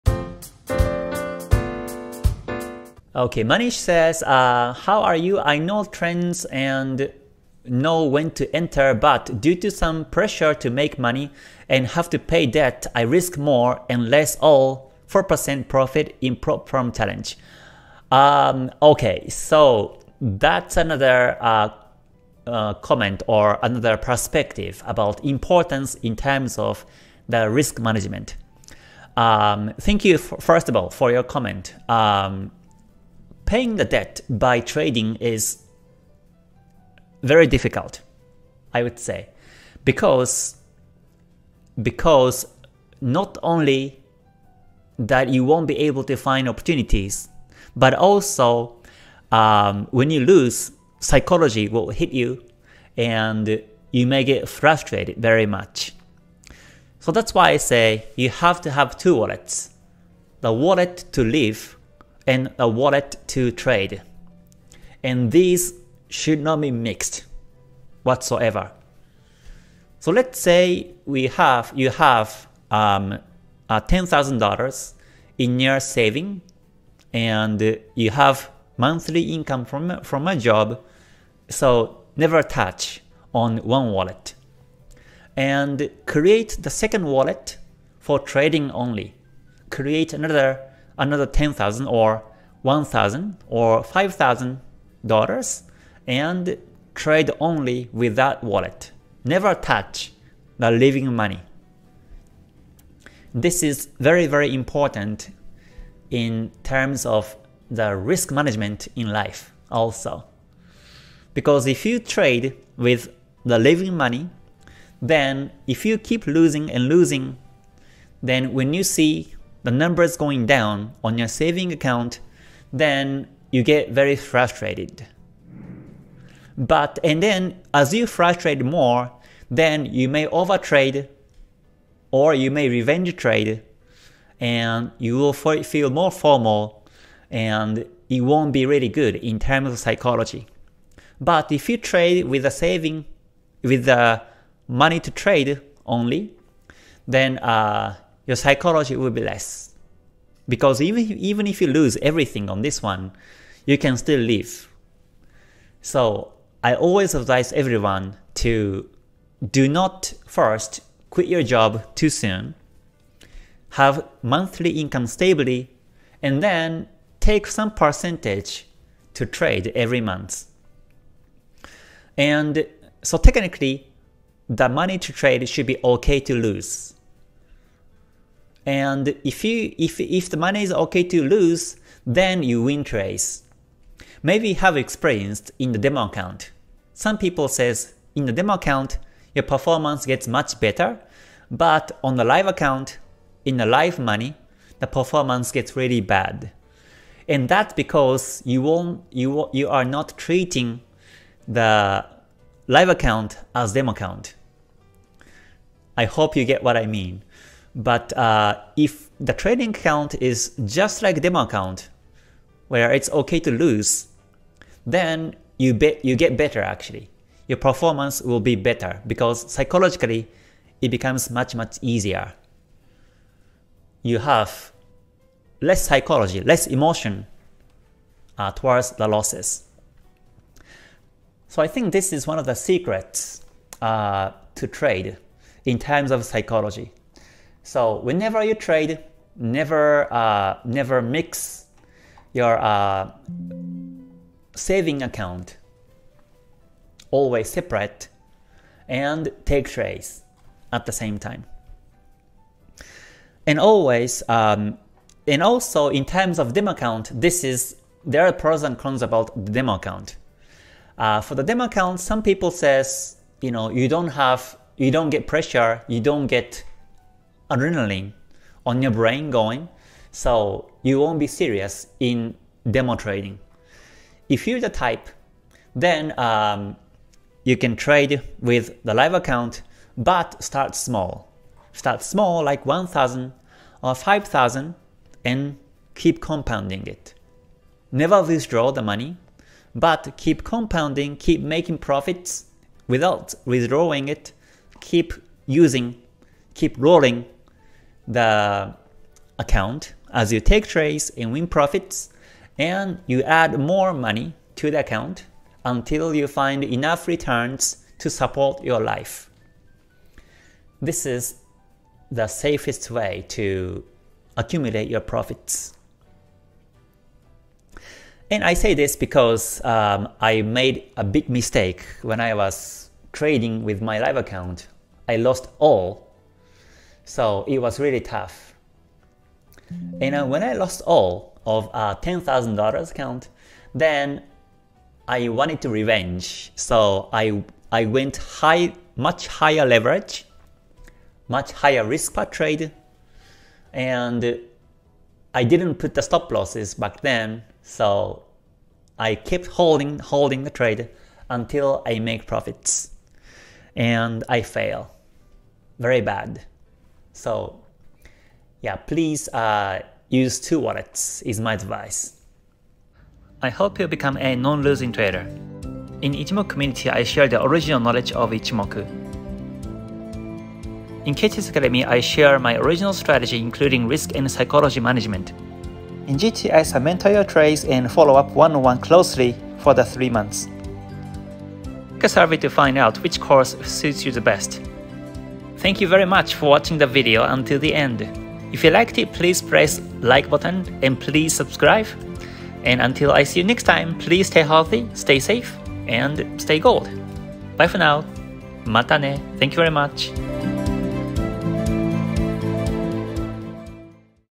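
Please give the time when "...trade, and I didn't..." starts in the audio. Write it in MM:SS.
05:42.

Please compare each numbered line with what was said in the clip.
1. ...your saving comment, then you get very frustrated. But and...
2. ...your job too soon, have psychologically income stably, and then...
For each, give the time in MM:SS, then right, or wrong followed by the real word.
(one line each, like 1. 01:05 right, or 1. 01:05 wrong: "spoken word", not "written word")
1. 02:01 wrong: "account", not "comment"
2. 02:41 wrong: "monthly", not "psychologically".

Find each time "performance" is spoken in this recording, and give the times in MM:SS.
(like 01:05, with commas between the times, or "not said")
03:09, 03:14, 03:37.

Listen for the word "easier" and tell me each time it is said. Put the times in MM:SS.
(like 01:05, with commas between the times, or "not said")
03:41.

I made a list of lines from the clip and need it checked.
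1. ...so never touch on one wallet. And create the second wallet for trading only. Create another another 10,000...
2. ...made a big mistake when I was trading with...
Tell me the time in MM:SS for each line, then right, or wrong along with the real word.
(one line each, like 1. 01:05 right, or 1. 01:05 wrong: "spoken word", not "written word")
1. 01:21 right
2. 05:20 right.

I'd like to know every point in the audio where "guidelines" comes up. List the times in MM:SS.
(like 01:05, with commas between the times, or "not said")
not said.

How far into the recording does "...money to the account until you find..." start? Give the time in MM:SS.
05:03.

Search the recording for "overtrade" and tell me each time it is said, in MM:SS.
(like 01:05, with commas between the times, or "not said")
02:10.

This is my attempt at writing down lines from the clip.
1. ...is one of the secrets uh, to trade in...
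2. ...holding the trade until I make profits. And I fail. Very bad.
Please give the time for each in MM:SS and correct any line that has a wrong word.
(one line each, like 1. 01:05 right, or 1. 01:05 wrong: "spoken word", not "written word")
1. 03:52 right
2. 05:49 right.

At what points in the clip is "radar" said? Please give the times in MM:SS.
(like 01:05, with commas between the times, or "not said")
not said.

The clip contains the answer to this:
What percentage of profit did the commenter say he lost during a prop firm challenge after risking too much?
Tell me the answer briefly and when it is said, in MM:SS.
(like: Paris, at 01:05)
4%, at 00:15.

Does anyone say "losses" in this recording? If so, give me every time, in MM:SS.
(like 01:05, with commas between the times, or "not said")
03:49, 05:46.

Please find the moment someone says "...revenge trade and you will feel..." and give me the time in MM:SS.
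02:12.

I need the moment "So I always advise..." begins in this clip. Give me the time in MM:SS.
02:35.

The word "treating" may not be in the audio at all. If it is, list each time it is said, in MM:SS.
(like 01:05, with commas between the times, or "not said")
03:20.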